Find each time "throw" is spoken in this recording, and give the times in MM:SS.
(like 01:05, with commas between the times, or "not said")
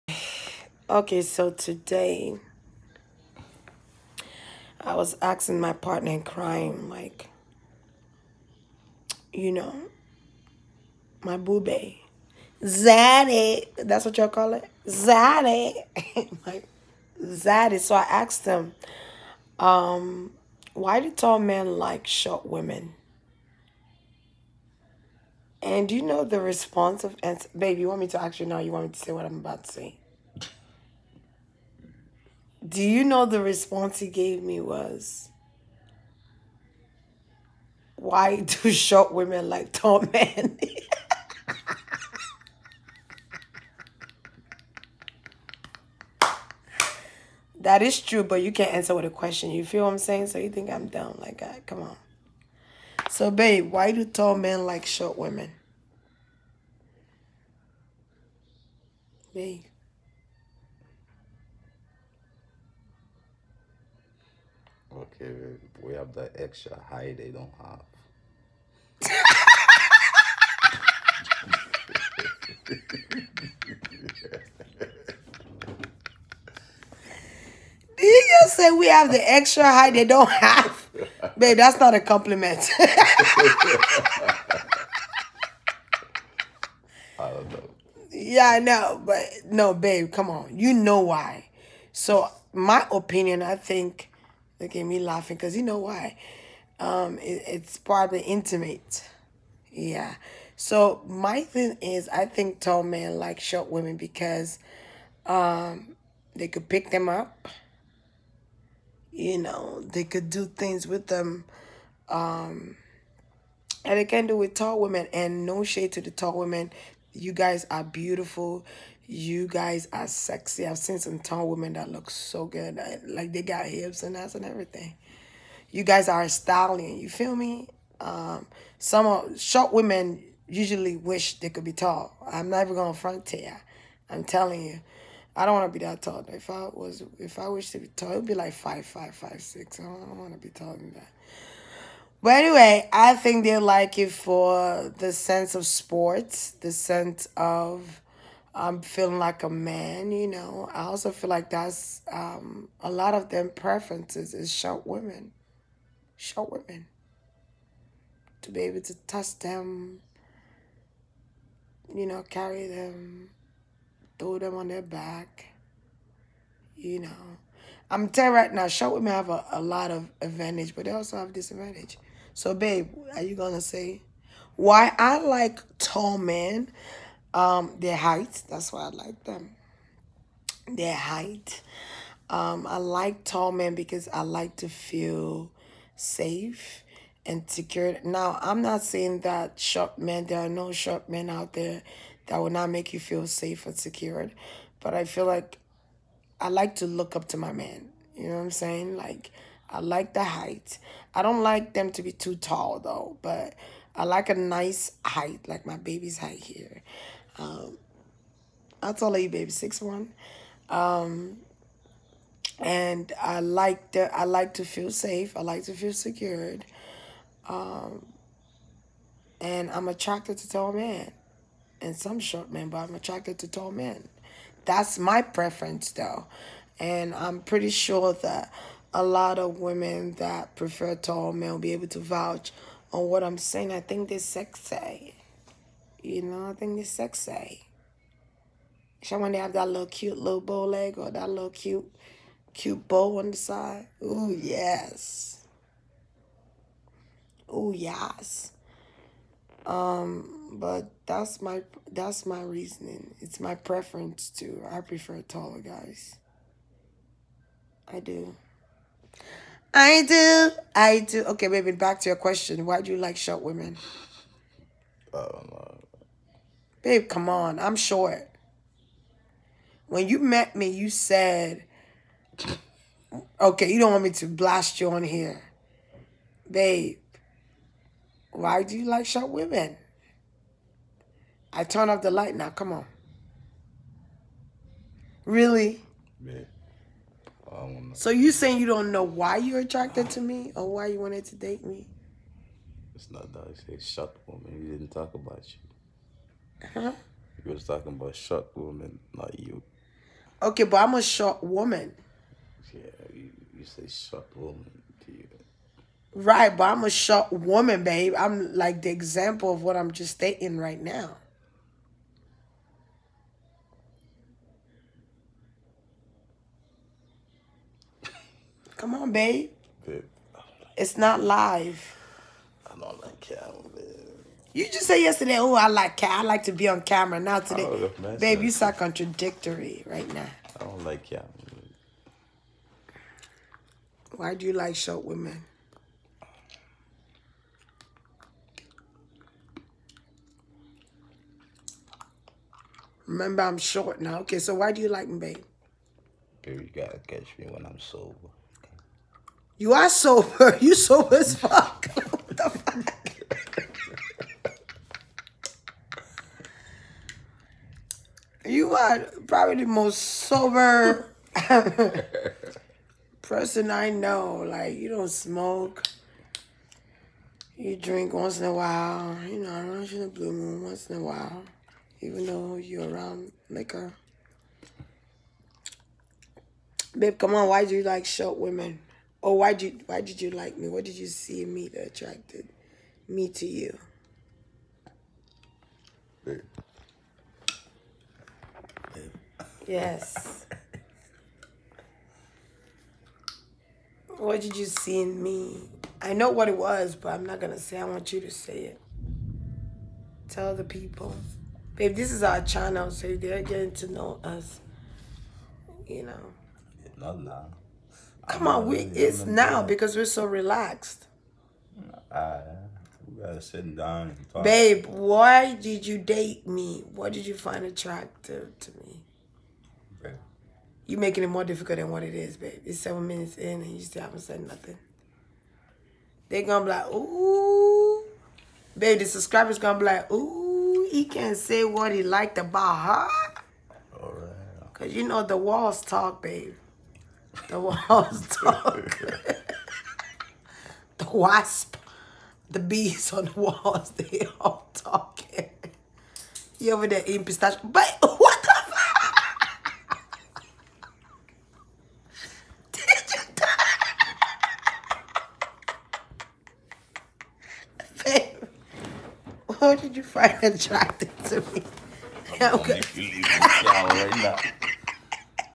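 02:44.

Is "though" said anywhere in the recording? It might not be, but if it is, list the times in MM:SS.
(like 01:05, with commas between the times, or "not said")
03:22, 03:45, 06:12.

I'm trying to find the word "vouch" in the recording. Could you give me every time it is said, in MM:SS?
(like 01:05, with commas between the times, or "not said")
03:51.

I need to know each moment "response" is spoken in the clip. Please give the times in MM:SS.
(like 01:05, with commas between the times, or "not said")
00:26, 00:33.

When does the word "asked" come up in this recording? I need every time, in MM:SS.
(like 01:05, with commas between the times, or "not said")
00:18.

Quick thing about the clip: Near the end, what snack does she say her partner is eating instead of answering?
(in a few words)
pistachio.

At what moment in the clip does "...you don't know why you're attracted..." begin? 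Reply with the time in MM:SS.
04:48.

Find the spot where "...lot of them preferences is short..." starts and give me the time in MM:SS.
02:32.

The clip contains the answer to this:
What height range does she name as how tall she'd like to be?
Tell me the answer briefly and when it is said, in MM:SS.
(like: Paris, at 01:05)
5'5 to 5'6, at 02:18.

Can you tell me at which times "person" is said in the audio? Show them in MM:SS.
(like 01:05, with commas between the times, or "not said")
06:03.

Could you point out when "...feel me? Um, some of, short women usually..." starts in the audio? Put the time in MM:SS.
02:07.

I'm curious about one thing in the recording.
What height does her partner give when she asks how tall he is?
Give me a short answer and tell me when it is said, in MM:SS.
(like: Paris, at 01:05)
6'1, at 03:29.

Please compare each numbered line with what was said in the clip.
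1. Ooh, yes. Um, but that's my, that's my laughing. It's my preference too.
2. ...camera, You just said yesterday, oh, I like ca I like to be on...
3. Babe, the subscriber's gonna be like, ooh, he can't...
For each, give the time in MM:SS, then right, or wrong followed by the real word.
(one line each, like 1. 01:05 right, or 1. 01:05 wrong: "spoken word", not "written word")
1. 04:07 wrong: "reasoning", not "laughing"
2. 05:23 right
3. 07:08 right.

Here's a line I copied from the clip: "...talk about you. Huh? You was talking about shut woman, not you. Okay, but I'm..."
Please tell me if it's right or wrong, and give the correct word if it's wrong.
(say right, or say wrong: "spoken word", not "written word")
right.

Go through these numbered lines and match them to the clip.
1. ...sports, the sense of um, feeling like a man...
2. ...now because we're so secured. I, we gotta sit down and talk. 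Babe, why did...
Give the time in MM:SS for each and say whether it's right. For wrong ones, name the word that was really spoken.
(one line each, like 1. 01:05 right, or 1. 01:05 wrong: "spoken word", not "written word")
1. 02:25 right
2. 06:49 wrong: "relaxed", not "secured".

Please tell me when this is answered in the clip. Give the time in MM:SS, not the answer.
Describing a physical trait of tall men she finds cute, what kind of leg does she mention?
04:00.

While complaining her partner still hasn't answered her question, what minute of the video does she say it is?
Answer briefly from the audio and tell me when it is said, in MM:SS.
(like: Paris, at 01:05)
7, at 07:02.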